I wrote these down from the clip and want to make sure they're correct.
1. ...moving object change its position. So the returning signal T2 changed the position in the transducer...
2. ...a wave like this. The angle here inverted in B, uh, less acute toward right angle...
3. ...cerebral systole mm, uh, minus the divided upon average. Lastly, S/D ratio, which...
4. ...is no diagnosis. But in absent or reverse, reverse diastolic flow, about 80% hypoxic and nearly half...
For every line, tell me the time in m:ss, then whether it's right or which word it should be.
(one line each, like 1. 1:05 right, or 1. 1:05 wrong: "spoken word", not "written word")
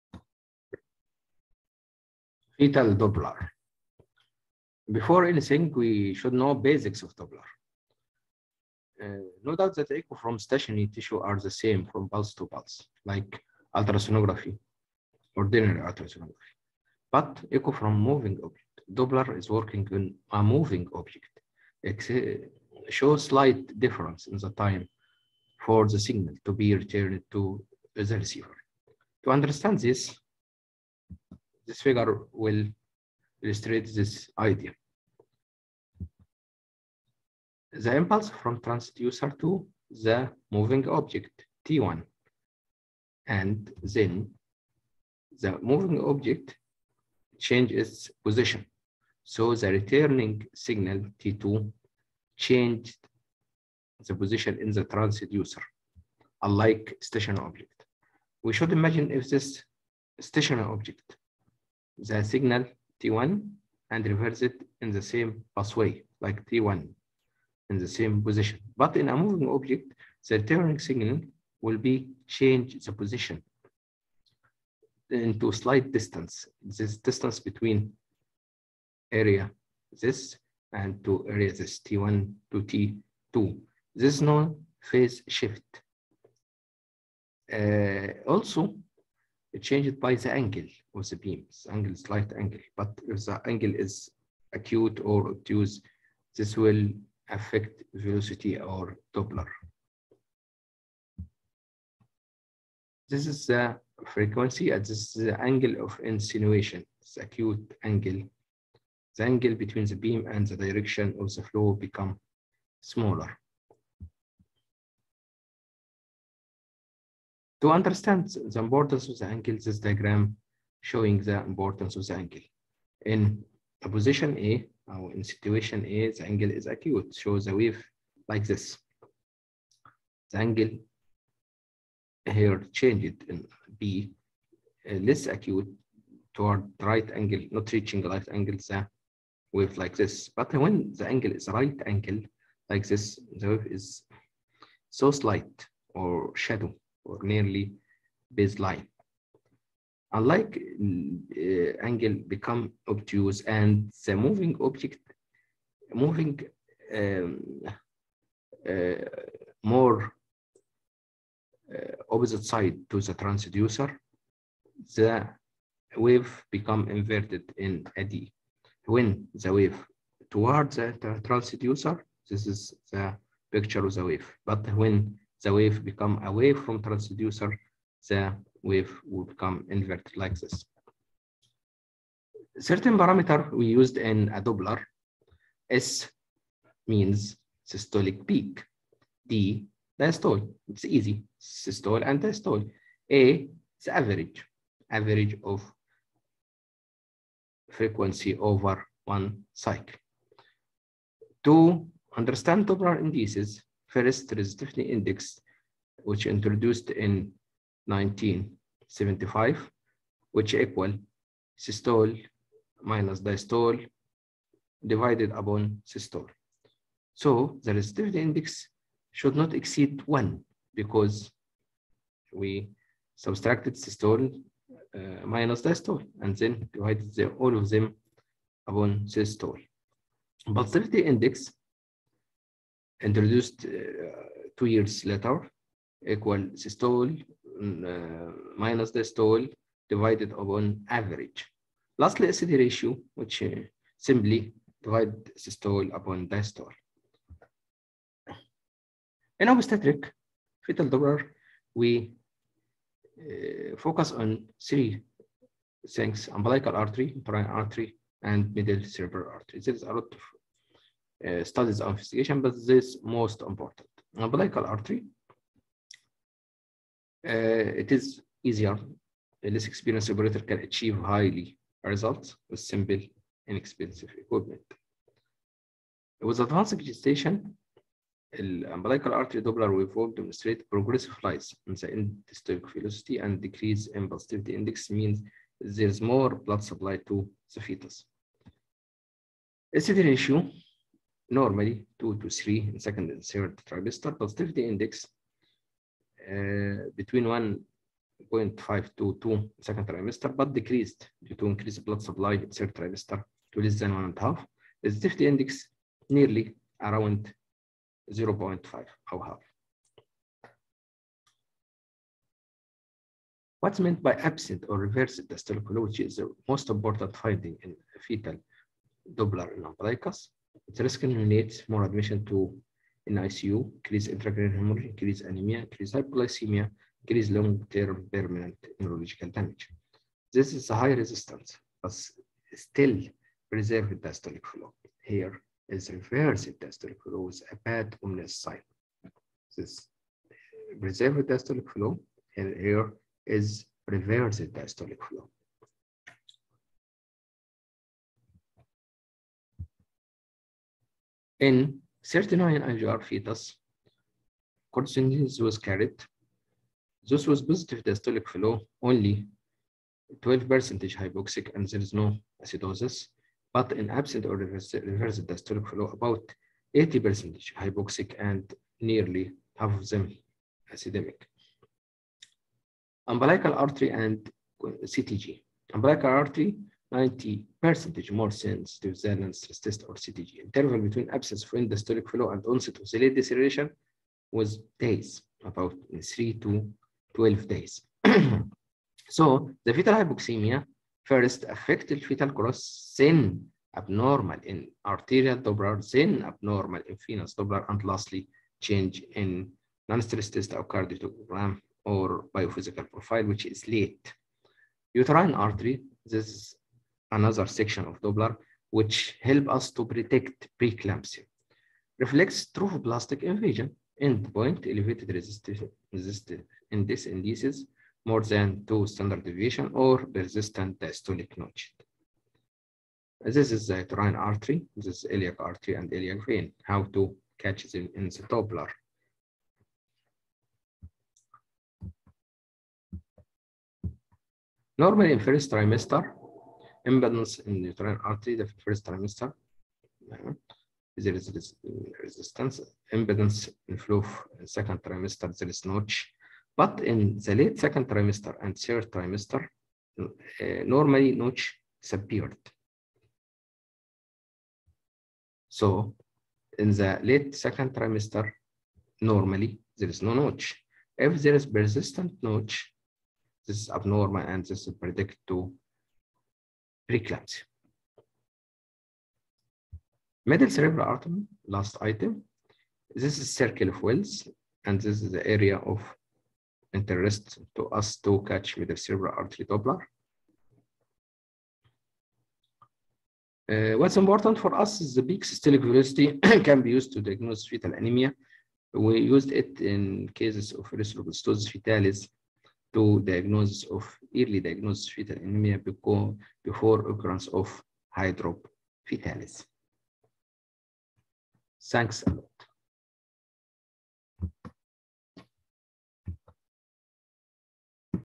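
1. 0:45 right
2. 2:07 wrong: "changed", not "inverted"
3. 3:56 wrong: "equal", not "cerebral"
4. 6:01 wrong: "acidosis", not "diagnosis".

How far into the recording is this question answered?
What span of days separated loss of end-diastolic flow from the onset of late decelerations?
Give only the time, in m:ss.
6:26.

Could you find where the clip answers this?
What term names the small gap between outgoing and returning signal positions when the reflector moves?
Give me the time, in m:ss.
1:24.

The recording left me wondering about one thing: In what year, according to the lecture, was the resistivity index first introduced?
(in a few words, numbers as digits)
1975.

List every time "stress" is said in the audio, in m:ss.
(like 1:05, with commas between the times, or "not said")
6:19, 6:39.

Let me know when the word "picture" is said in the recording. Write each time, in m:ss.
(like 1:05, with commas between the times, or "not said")
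2:53.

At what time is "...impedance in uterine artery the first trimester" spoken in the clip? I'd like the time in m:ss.
7:16.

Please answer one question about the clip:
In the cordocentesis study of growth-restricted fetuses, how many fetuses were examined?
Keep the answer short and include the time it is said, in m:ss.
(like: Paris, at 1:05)
39, at 5:52.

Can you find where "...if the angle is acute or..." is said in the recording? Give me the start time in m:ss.
1:33.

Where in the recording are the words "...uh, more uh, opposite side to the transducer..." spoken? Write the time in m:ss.
2:38.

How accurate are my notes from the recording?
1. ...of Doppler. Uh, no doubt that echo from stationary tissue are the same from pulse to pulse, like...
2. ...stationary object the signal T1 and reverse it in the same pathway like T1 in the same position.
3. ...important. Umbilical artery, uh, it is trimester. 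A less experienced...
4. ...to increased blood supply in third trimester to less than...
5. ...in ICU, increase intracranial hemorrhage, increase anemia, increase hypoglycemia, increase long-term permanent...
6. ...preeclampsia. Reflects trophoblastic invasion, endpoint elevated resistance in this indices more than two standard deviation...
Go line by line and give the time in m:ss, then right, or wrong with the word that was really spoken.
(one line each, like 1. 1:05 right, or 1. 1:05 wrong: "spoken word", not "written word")
1. 0:07 right
2. 1:00 right
3. 4:23 wrong: "easier", not "trimester"
4. 5:01 right
5. 5:23 right
6. 6:50 right.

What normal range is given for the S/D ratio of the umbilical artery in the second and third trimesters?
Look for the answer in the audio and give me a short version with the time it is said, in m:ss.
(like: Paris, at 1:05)
2 to 3, at 4:51.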